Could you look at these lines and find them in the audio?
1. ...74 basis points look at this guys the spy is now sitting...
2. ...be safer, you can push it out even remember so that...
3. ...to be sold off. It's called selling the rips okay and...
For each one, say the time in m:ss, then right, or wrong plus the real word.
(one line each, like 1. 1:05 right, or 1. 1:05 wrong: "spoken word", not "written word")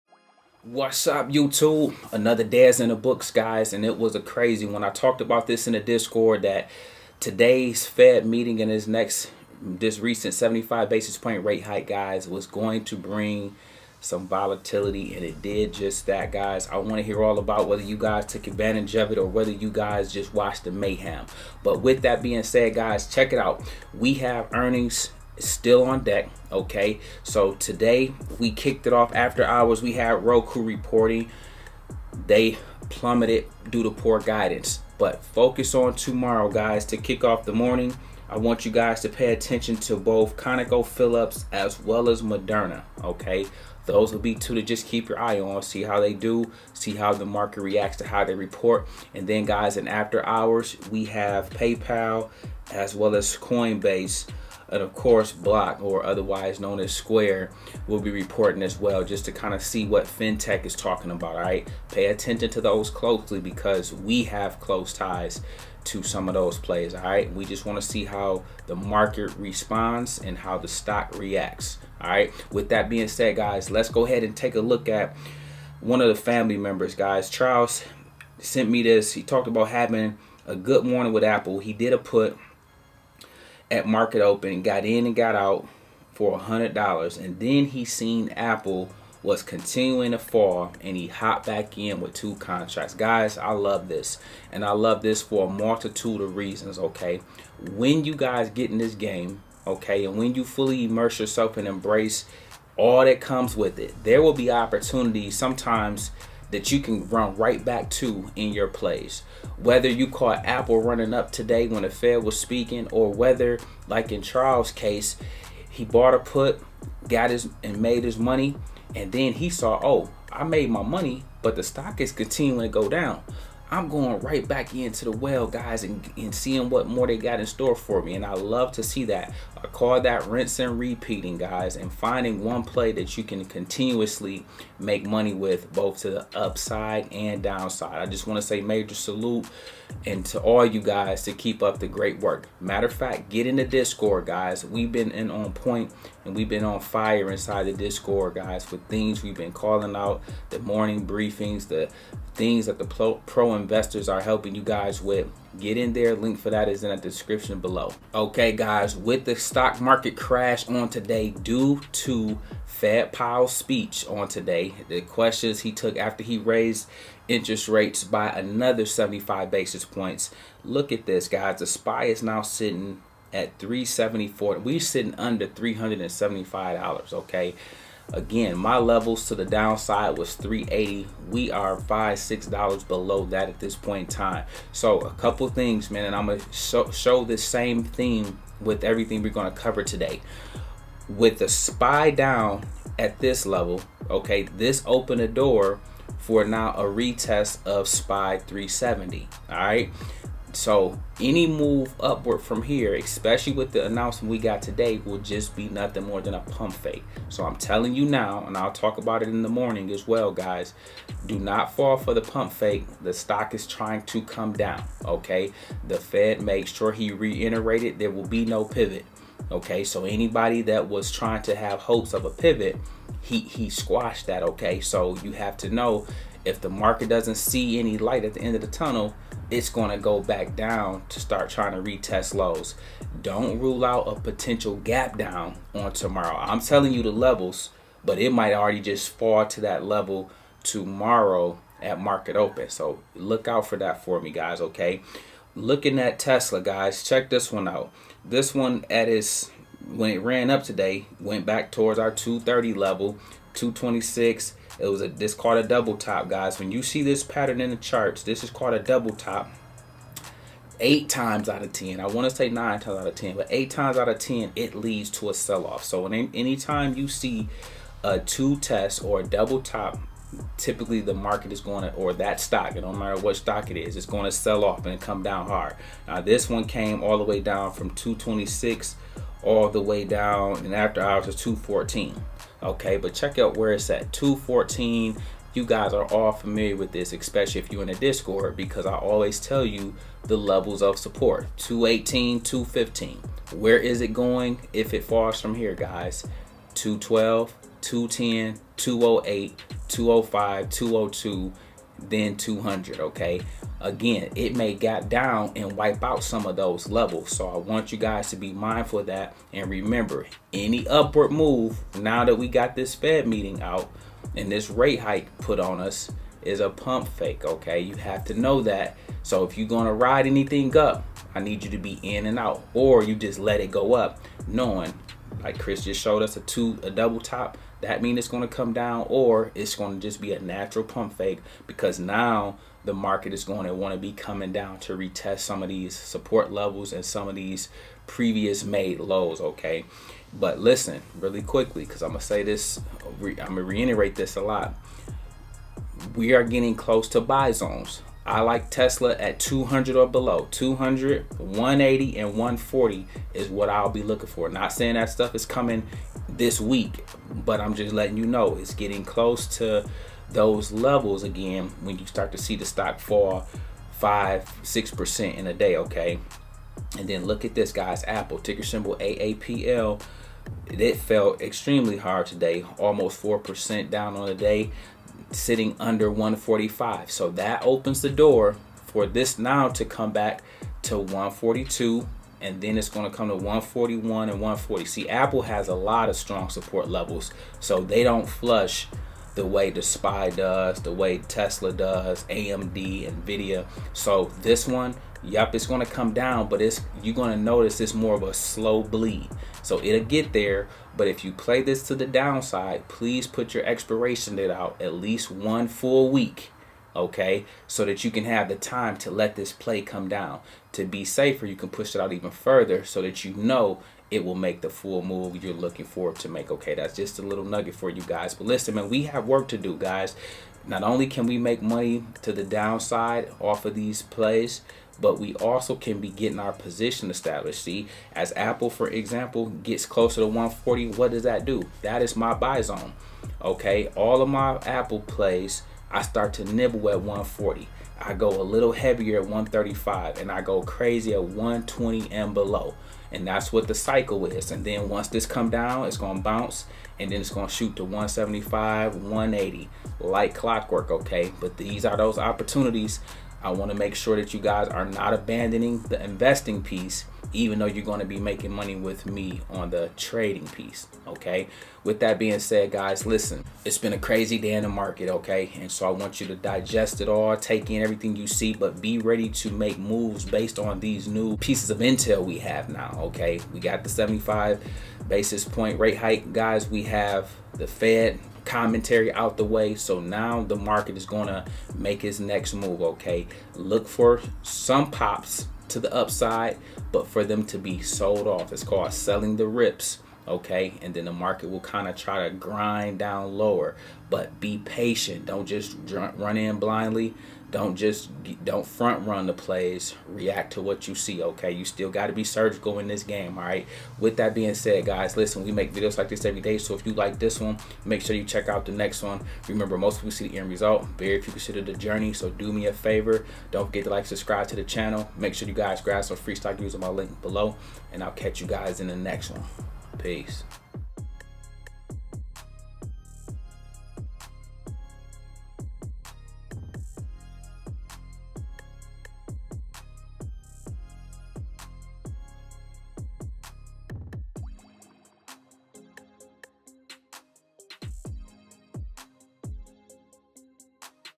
1. 2:48 wrong: "75", not "74"
2. 6:50 wrong: "further", not "remember"
3. 8:07 right.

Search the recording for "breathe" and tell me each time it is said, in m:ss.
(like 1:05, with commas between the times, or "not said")
not said.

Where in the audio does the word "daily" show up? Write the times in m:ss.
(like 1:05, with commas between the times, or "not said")
not said.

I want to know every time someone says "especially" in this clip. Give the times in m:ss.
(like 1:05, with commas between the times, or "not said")
3:22, 4:47.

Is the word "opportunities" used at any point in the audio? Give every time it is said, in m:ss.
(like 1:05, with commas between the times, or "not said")
1:44, 7:32.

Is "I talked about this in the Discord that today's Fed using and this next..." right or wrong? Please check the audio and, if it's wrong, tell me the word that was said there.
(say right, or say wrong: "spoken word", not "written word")
wrong: "meeting", not "using".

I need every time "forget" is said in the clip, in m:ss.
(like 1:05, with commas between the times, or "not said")
8:33.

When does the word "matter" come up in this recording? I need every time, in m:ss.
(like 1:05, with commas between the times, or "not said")
2:22, 4:32.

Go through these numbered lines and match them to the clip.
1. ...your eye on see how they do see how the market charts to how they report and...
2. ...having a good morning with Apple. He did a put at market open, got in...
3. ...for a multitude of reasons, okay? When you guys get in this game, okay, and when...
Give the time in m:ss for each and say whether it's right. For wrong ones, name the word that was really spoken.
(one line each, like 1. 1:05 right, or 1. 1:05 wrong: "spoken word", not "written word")
1. 0:45 wrong: "reacts", not "charts"
2. 1:19 right
3. 1:35 right.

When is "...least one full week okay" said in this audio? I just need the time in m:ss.
6:44.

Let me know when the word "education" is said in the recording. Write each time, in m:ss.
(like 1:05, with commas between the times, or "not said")
not said.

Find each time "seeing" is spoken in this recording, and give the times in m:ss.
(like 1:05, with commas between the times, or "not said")
2:06.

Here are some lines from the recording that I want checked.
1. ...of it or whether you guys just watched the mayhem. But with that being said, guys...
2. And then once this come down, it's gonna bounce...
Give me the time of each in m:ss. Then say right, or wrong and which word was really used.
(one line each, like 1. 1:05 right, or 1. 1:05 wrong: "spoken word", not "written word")
1. 0:18 right
2. 7:24 right.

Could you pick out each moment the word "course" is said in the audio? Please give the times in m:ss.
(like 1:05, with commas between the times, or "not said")
0:54.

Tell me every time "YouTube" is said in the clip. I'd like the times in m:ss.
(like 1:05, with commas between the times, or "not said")
0:01.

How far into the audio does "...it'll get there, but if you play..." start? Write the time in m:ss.
6:39.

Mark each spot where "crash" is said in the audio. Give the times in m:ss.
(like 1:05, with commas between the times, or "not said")
2:40.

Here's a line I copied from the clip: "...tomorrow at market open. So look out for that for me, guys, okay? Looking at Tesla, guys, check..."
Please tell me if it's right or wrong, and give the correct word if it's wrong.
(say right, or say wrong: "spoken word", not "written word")
right.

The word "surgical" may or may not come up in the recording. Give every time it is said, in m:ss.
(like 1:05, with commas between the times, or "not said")
8:22.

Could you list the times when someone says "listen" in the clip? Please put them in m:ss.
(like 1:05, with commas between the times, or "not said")
5:40, 6:58, 7:43, 8:25.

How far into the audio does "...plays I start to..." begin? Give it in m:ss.
7:14.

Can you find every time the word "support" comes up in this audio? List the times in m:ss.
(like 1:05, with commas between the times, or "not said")
4:50, 5:35, 6:26.